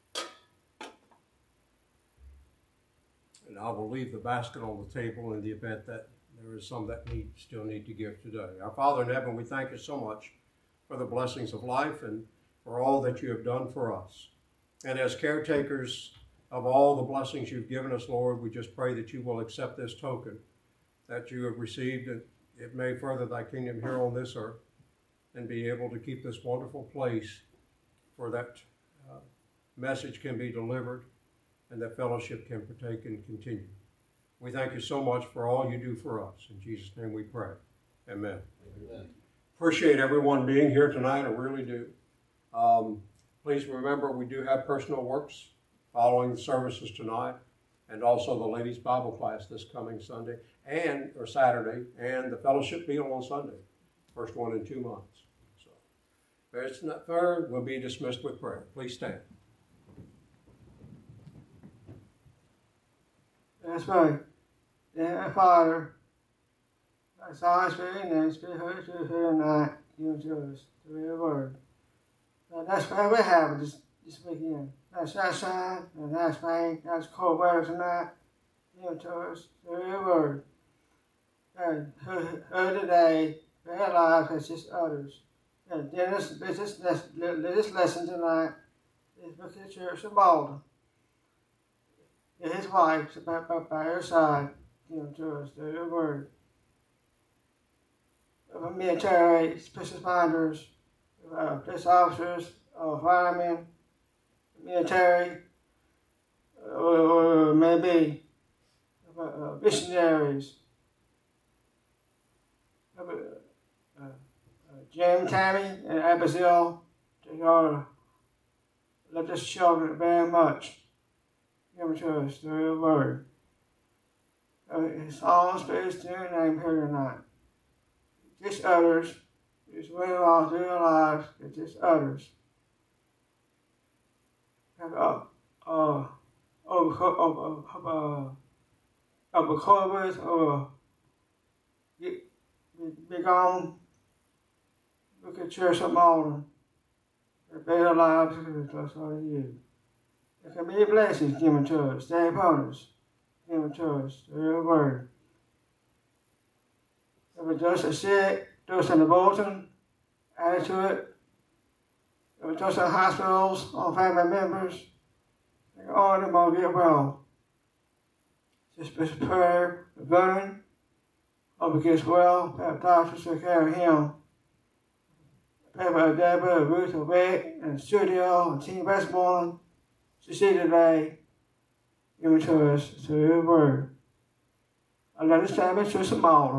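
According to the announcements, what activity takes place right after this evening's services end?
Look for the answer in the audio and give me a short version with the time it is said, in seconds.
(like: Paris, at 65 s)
Personal works, at 44 s.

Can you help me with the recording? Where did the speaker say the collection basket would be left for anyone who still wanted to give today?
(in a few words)
On the table.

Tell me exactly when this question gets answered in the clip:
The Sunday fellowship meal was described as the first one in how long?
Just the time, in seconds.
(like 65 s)
54 s.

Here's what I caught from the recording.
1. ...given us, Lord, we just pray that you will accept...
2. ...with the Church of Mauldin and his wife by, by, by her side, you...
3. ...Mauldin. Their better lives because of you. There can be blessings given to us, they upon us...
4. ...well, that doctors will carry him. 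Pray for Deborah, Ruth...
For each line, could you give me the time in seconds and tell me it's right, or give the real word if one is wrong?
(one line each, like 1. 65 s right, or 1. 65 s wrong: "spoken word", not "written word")
1. 17 s right
2. 89 s right
3. 145 s right
4. 172 s right.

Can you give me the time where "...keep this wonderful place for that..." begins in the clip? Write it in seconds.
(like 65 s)
25 s.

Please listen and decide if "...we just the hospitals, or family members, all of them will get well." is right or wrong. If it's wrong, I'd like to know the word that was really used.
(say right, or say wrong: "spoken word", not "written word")
right.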